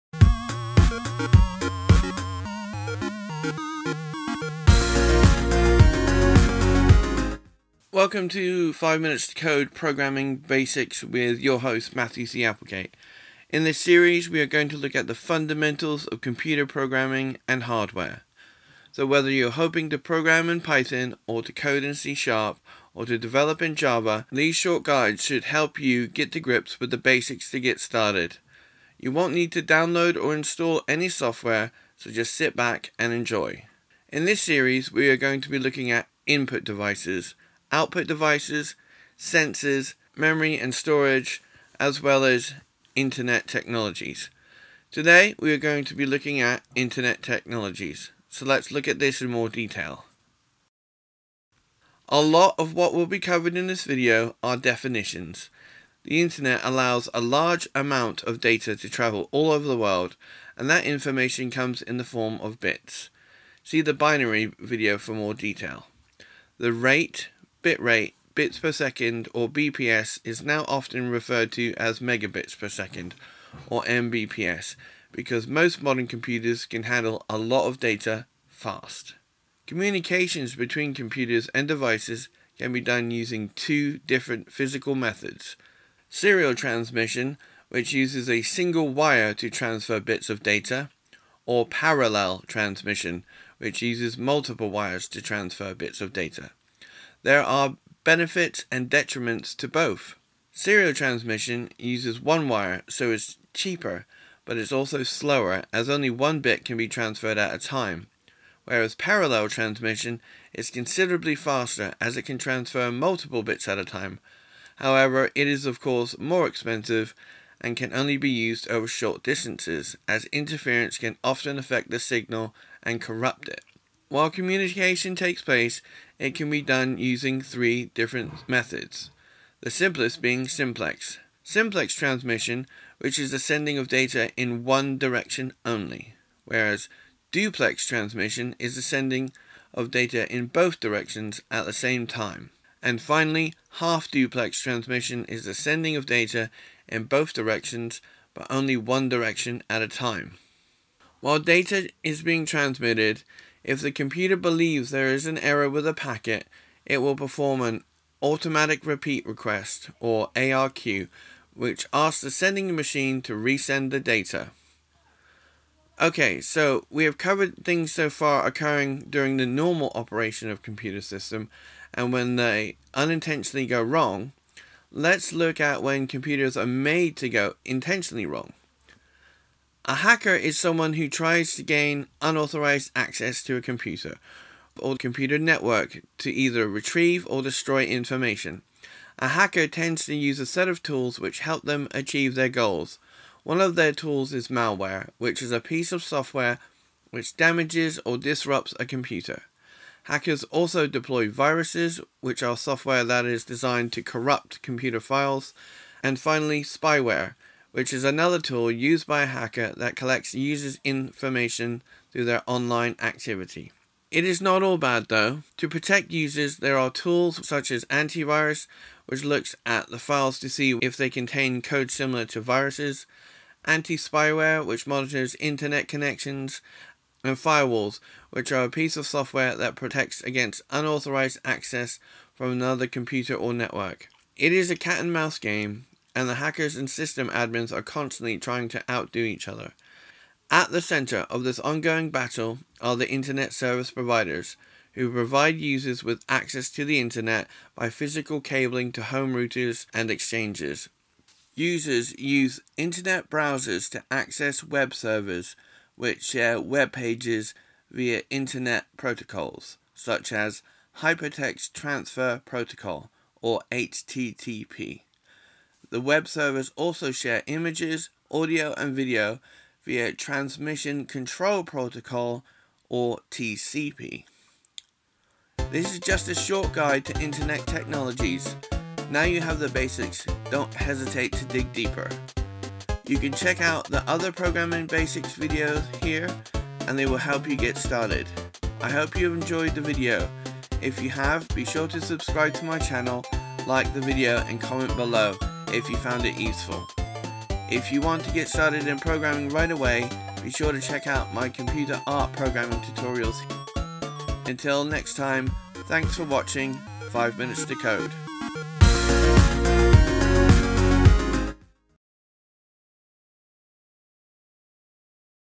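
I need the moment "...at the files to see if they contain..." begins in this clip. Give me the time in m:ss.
3:39.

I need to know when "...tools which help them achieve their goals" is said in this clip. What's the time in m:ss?
3:10.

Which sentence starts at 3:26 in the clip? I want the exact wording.
And finally, spyware, which is another tool used by a hacker that collects users' information through their online activity.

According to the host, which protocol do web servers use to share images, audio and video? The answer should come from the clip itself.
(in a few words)
Transmission Control Protocol.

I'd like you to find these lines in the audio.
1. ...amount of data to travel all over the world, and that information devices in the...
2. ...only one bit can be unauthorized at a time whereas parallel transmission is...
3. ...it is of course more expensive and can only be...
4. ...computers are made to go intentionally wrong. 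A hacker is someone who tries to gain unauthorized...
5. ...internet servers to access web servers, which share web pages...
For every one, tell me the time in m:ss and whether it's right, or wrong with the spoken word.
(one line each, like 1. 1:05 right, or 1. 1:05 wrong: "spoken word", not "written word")
1. 0:57 wrong: "comes", not "devices"
2. 1:45 wrong: "transferred", not "unauthorized"
3. 1:55 right
4. 2:56 right
5. 4:12 wrong: "browsers", not "servers".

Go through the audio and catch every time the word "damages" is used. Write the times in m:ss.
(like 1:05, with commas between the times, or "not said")
3:17.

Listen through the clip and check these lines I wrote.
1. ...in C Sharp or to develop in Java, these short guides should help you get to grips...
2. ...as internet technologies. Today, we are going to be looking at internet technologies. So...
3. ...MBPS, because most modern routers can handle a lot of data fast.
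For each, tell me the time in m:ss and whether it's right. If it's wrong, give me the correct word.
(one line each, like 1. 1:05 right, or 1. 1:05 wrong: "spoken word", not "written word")
1. 0:21 right
2. 0:42 right
3. 1:13 wrong: "computers", not "routers".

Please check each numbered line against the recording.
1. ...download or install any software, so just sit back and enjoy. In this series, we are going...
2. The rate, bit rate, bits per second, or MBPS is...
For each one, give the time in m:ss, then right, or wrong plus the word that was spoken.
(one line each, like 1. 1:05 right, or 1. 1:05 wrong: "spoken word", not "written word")
1. 0:29 right
2. 1:06 wrong: "BPS", not "MBPS".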